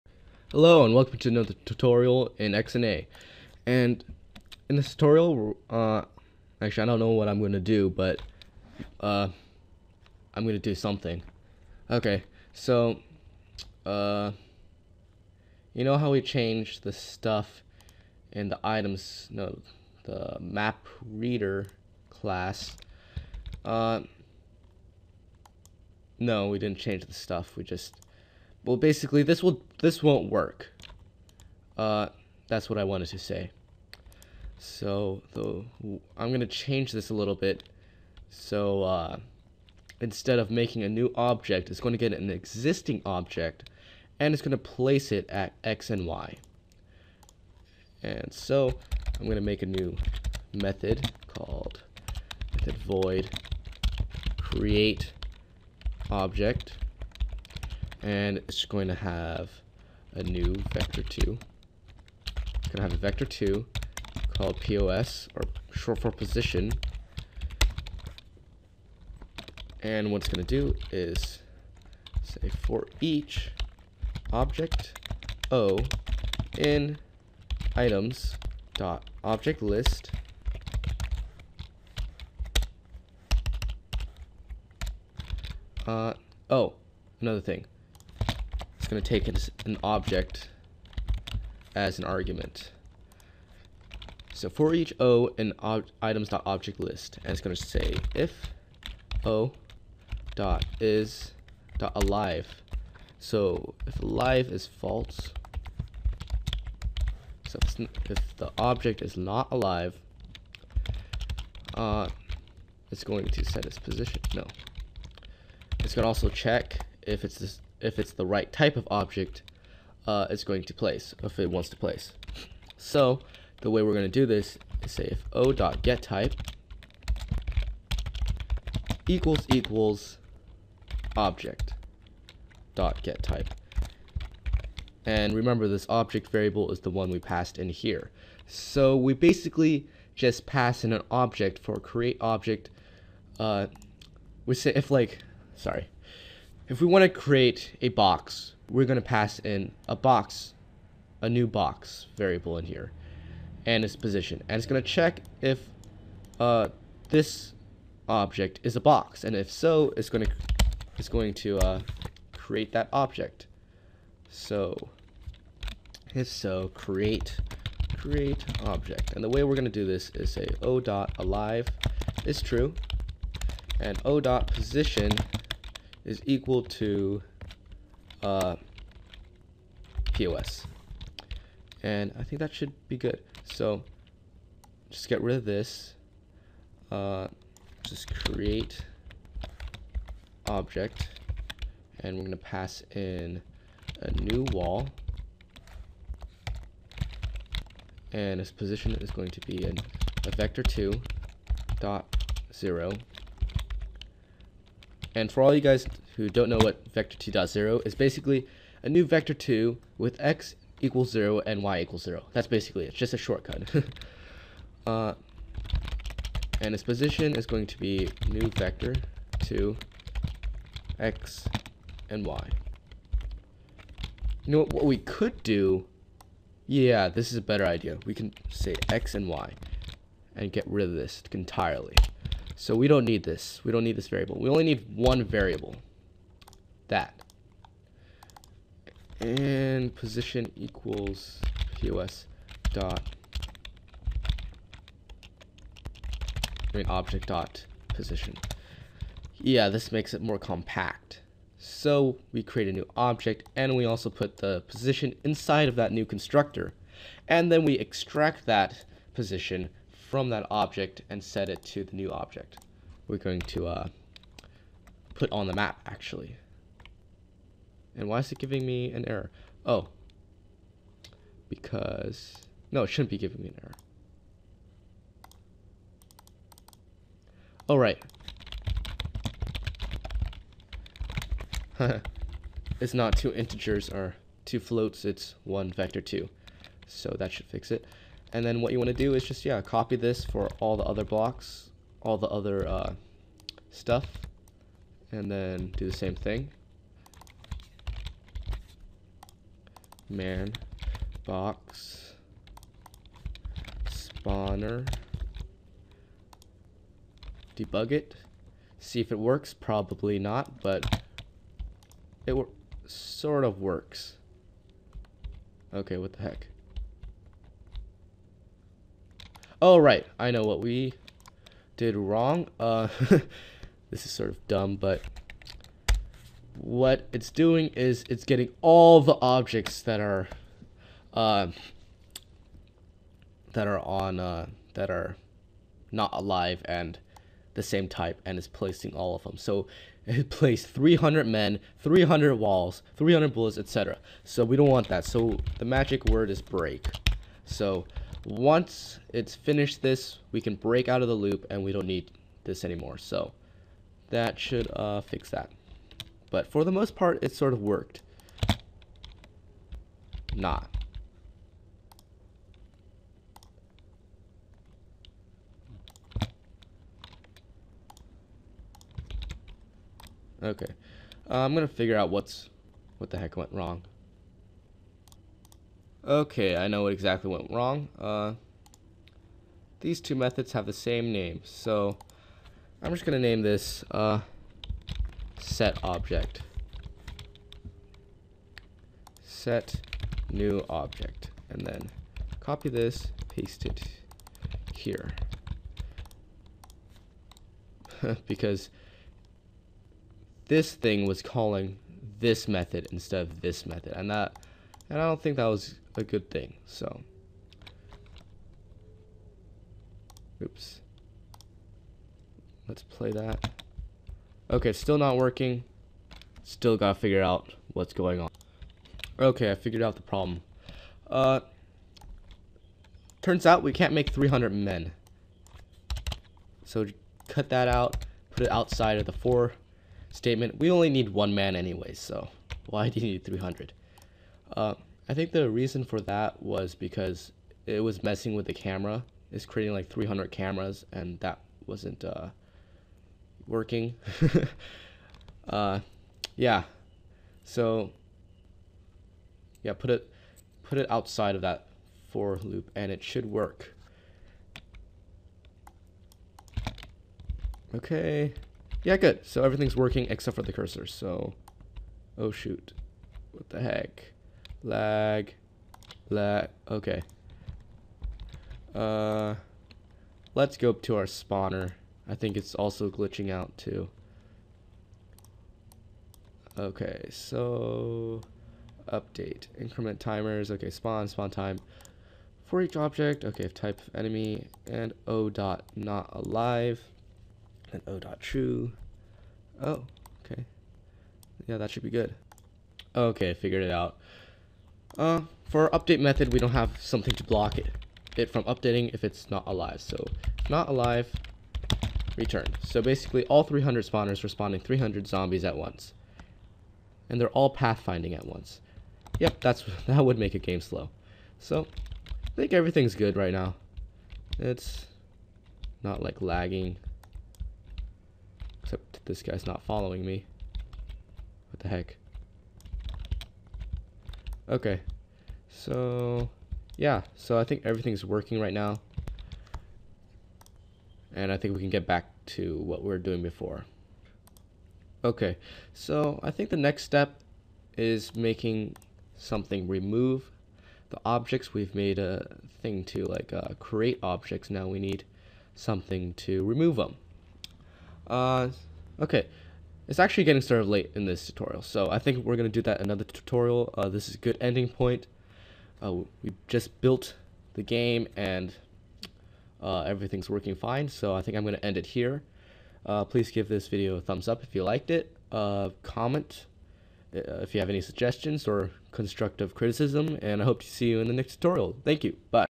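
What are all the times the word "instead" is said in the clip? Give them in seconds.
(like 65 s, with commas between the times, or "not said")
39 s, 402 s.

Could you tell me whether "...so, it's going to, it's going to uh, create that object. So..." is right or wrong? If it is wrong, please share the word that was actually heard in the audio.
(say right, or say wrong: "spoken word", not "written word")
right.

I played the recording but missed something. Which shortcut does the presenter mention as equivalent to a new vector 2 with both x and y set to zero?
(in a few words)
vector 2.0.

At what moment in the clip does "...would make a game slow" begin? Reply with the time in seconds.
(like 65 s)
510 s.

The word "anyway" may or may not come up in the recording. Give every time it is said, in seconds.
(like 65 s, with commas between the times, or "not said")
431 s.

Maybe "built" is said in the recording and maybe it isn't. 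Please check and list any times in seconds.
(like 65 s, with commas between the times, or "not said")
556 s.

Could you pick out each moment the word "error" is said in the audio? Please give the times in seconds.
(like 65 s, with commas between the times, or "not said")
269 s, 273 s.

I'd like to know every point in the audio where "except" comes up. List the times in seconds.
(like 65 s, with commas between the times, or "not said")
460 s, 518 s.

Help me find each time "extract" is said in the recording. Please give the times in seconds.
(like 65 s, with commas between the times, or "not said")
257 s.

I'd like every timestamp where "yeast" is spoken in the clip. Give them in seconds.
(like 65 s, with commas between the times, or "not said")
not said.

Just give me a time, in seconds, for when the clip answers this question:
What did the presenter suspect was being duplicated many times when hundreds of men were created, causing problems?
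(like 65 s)
438 s.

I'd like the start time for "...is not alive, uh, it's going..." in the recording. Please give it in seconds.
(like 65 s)
109 s.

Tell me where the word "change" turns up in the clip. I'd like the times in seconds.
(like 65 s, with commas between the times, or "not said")
16 s, 26 s, 36 s.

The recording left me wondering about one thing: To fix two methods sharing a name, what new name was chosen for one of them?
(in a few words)
set new object.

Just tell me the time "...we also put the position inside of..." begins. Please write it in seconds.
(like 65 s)
253 s.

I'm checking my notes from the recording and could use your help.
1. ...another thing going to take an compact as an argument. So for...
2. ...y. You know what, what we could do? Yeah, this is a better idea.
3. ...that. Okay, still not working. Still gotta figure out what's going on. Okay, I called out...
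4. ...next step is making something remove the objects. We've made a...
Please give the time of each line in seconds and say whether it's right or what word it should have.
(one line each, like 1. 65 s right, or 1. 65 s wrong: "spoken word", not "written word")
1. 87 s wrong: "object", not "compact"
2. 222 s right
3. 413 s wrong: "figured", not "called"
4. 536 s right.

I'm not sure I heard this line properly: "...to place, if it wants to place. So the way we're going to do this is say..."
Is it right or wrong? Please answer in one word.
right.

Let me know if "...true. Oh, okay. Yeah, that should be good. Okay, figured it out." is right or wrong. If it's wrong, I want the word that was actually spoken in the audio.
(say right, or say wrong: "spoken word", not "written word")
right.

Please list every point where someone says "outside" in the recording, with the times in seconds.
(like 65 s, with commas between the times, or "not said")
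428 s, 450 s.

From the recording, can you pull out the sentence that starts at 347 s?
So once it's finished this, we can break out of the loop and we don't need this anymore.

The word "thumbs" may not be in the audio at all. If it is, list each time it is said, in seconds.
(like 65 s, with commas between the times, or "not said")
564 s.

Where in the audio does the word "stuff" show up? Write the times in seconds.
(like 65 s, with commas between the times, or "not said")
16 s, 27 s, 293 s.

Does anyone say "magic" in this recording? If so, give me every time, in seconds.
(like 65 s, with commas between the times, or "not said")
345 s.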